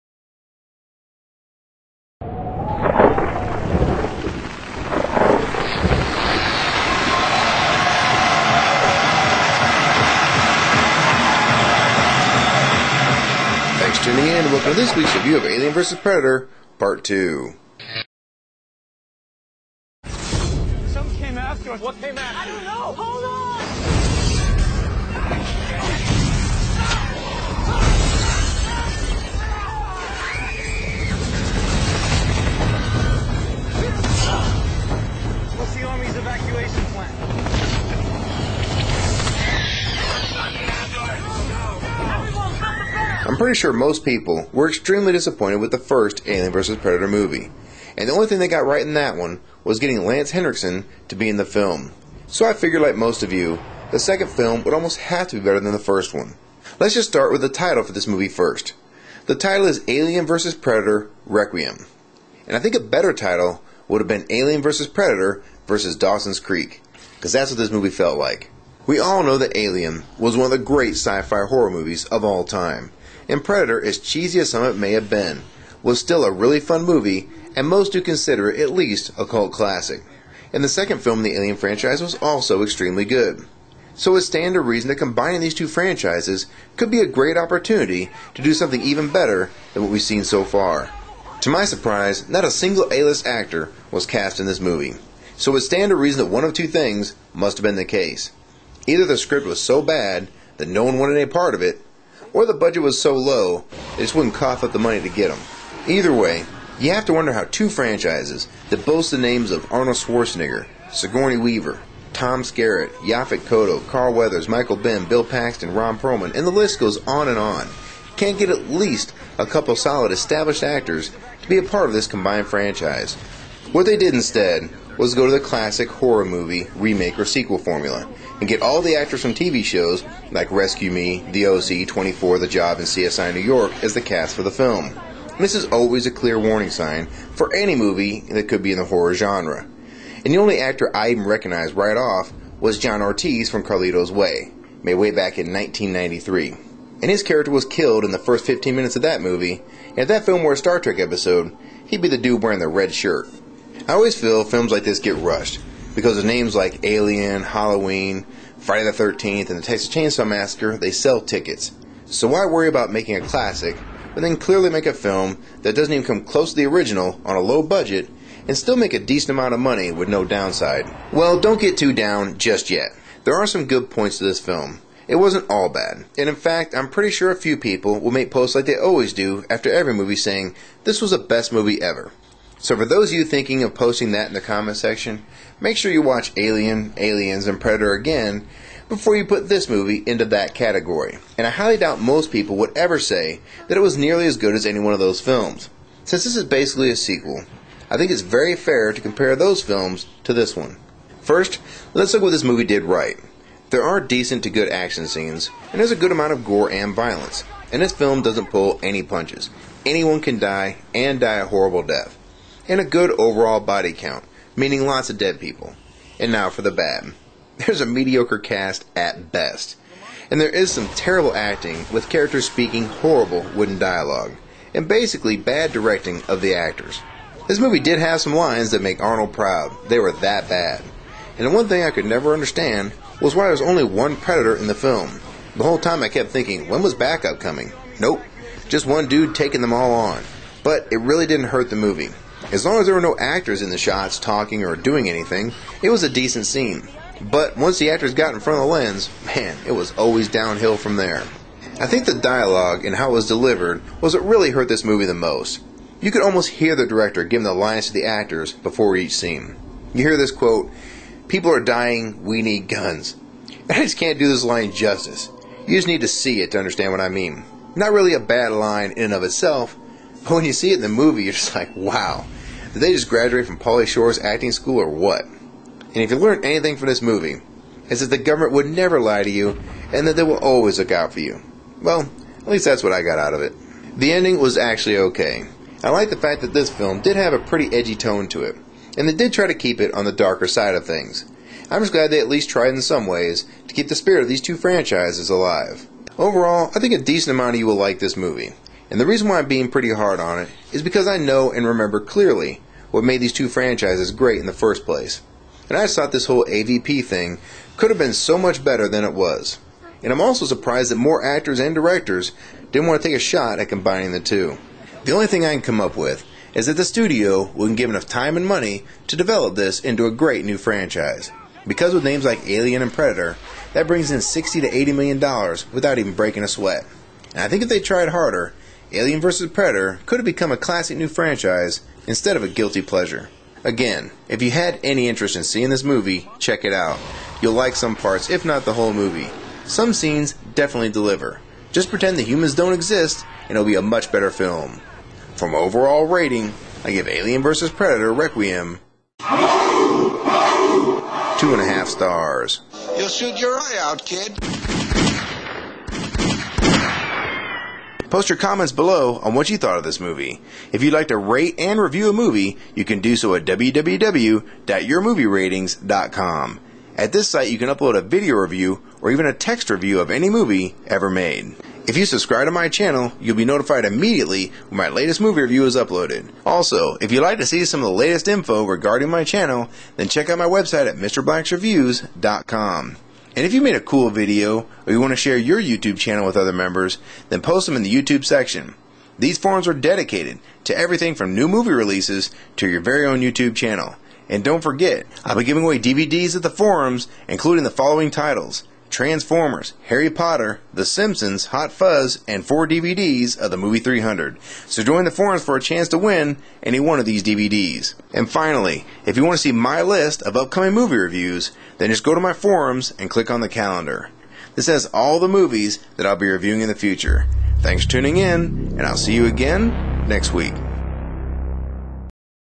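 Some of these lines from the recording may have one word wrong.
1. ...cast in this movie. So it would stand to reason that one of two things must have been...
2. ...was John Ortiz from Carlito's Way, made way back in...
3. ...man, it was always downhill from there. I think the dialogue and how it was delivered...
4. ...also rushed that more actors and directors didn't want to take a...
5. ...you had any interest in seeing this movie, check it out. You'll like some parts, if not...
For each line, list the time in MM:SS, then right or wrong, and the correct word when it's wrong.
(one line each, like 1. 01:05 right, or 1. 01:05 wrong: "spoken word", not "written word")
1. 01:34 right
2. 02:22 right
3. 04:09 right
4. 05:10 wrong: "surprised", not "rushed"
5. 05:34 right.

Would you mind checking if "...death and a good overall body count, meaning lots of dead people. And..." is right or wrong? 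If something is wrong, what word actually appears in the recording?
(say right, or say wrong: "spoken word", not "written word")
right.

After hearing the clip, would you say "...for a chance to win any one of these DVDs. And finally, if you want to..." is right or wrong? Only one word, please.
right.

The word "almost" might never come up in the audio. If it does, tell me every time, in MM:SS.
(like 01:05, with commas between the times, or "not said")
00:54, 04:16.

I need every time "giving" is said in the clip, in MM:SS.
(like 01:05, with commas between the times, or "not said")
04:17, 06:35.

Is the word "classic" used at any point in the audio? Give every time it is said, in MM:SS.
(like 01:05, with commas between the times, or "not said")
01:19, 02:05, 02:43, 05:30.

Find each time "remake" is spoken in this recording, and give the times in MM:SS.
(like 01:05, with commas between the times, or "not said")
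02:06.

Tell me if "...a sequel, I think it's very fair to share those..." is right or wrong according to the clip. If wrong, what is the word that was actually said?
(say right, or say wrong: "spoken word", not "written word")
wrong: "compare", not "share".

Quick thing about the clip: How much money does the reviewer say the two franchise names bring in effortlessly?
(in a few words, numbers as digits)
60 to 80 million dollars.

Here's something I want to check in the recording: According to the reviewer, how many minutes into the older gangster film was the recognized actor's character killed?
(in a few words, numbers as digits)
15.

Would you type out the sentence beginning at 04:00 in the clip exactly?
But it really didn't hurt the movie.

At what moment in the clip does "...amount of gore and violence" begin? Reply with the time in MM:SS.
03:26.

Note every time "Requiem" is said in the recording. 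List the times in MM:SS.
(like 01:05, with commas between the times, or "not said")
01:01, 05:48.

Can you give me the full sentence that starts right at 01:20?
And the second film in the Alien franchise was also extremely good.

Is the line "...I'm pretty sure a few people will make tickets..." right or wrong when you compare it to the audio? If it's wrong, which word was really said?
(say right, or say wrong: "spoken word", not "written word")
wrong: "posts", not "tickets".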